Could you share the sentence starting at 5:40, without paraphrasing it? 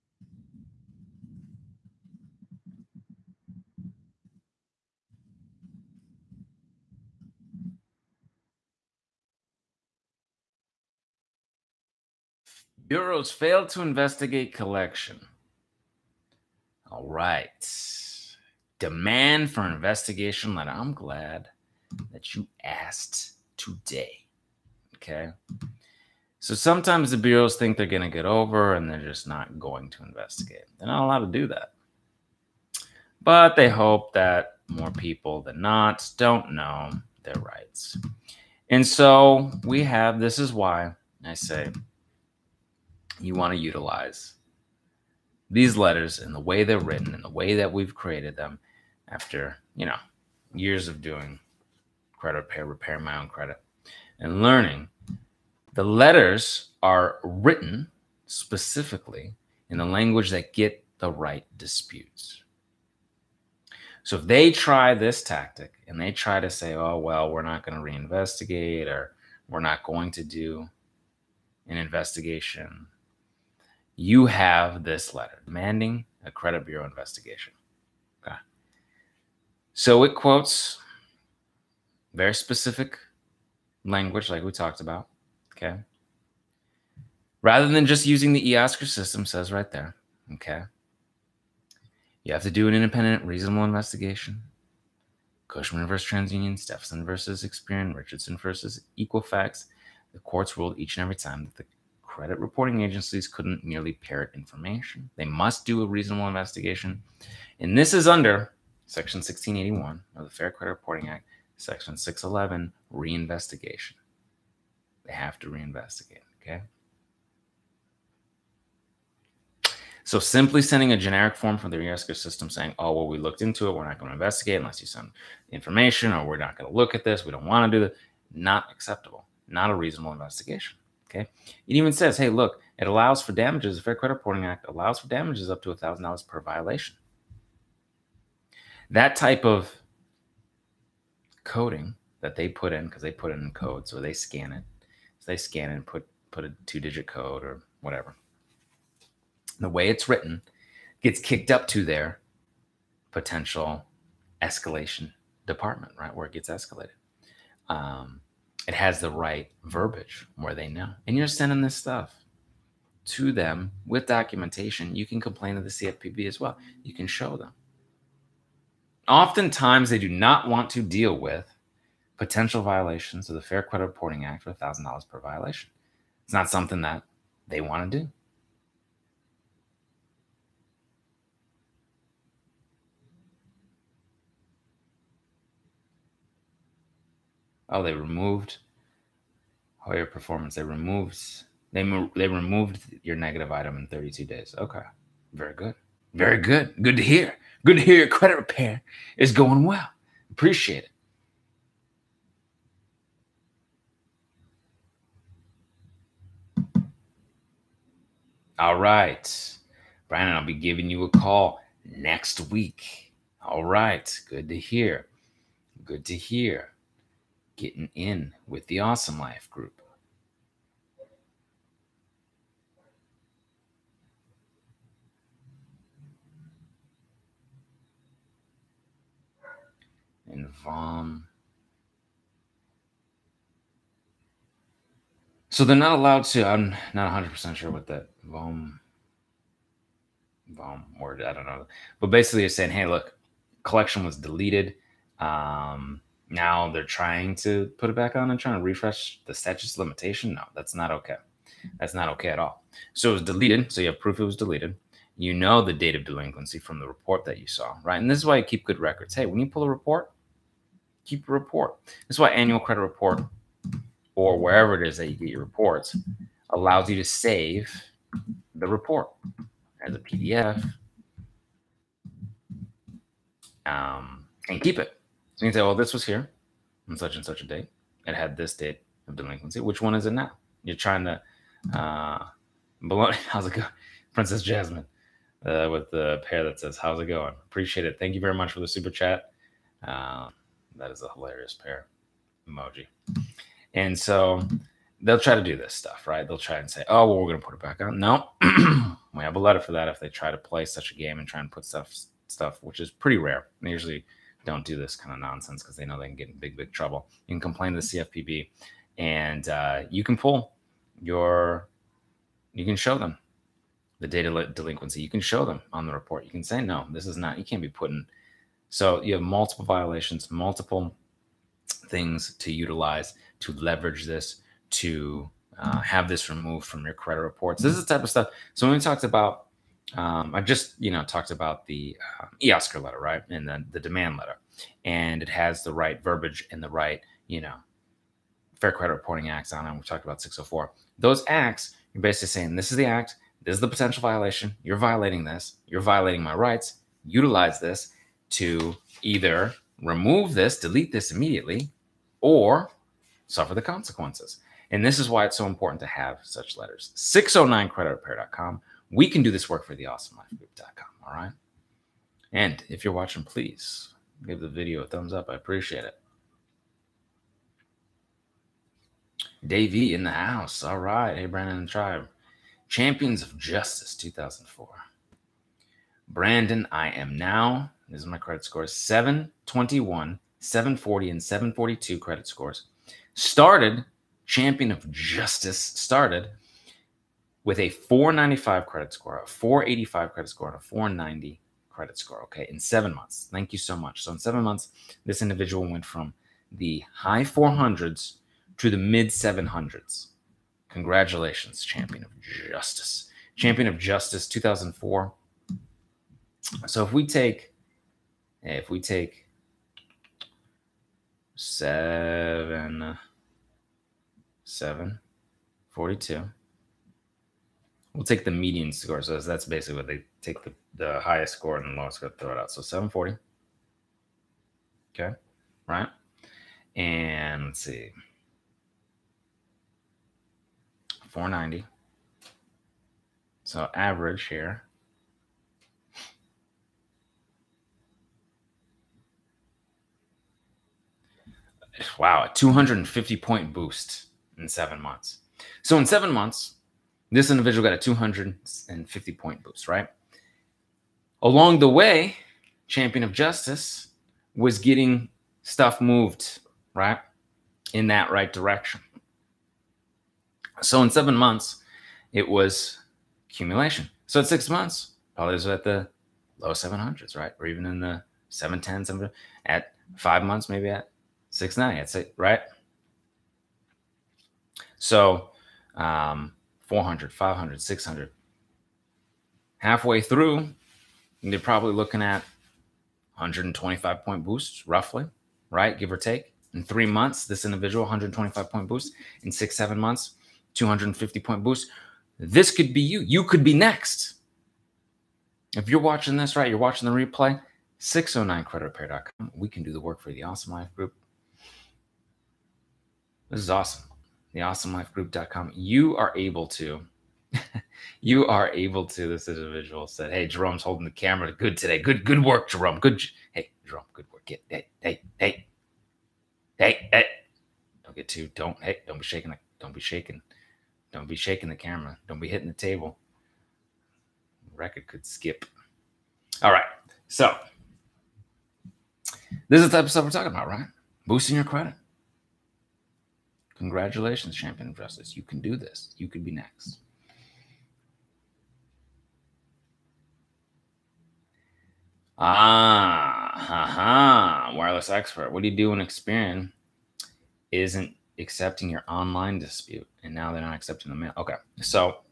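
Those acts, you're basically saying this is the act, this is the potential violation.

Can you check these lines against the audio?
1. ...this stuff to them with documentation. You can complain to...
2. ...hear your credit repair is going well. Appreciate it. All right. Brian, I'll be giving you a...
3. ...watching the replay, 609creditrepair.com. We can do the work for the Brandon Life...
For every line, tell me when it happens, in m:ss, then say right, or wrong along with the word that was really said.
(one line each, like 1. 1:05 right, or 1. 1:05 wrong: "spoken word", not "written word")
1. 2:41 right
2. 3:17 right
3. 8:16 wrong: "Awesome", not "Brandon".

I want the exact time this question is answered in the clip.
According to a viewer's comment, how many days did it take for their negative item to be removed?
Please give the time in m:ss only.
3:13.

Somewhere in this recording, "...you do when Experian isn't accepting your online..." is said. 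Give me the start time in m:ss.
9:05.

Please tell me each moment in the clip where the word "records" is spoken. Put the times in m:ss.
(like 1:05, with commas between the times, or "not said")
4:18, 8:44.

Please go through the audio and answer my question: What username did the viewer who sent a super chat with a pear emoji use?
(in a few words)
Princess Jasmine.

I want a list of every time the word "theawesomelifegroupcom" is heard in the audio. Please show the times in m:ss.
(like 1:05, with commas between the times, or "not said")
8:24.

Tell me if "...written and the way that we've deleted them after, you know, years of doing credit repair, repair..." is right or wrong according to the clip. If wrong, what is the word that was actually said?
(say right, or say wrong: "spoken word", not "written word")
wrong: "created", not "deleted".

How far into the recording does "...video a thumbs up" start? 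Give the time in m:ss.
6:04.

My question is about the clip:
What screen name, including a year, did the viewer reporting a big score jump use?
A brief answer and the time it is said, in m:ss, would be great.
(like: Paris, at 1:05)
Champions of Justice 2004, at 6:12.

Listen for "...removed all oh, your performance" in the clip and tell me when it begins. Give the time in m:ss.
3:07.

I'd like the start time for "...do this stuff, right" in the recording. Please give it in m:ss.
4:55.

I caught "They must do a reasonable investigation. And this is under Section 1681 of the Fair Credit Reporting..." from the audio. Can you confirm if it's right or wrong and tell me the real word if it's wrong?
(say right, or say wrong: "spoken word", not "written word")
right.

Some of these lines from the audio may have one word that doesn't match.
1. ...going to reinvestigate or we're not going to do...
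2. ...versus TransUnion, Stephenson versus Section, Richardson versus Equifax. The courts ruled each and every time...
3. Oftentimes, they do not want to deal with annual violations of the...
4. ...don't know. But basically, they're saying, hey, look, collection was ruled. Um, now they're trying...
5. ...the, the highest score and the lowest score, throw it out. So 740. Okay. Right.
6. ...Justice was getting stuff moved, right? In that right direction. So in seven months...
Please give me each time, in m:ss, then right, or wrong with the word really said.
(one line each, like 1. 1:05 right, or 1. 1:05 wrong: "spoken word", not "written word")
1. 1:07 right
2. 1:35 wrong: "Experian", not "Section"
3. 2:49 wrong: "potential", not "annual"
4. 4:01 wrong: "deleted", not "ruled"
5. 7:00 right
6. 7:33 right.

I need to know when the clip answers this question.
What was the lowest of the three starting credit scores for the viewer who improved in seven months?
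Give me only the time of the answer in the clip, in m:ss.
6:29.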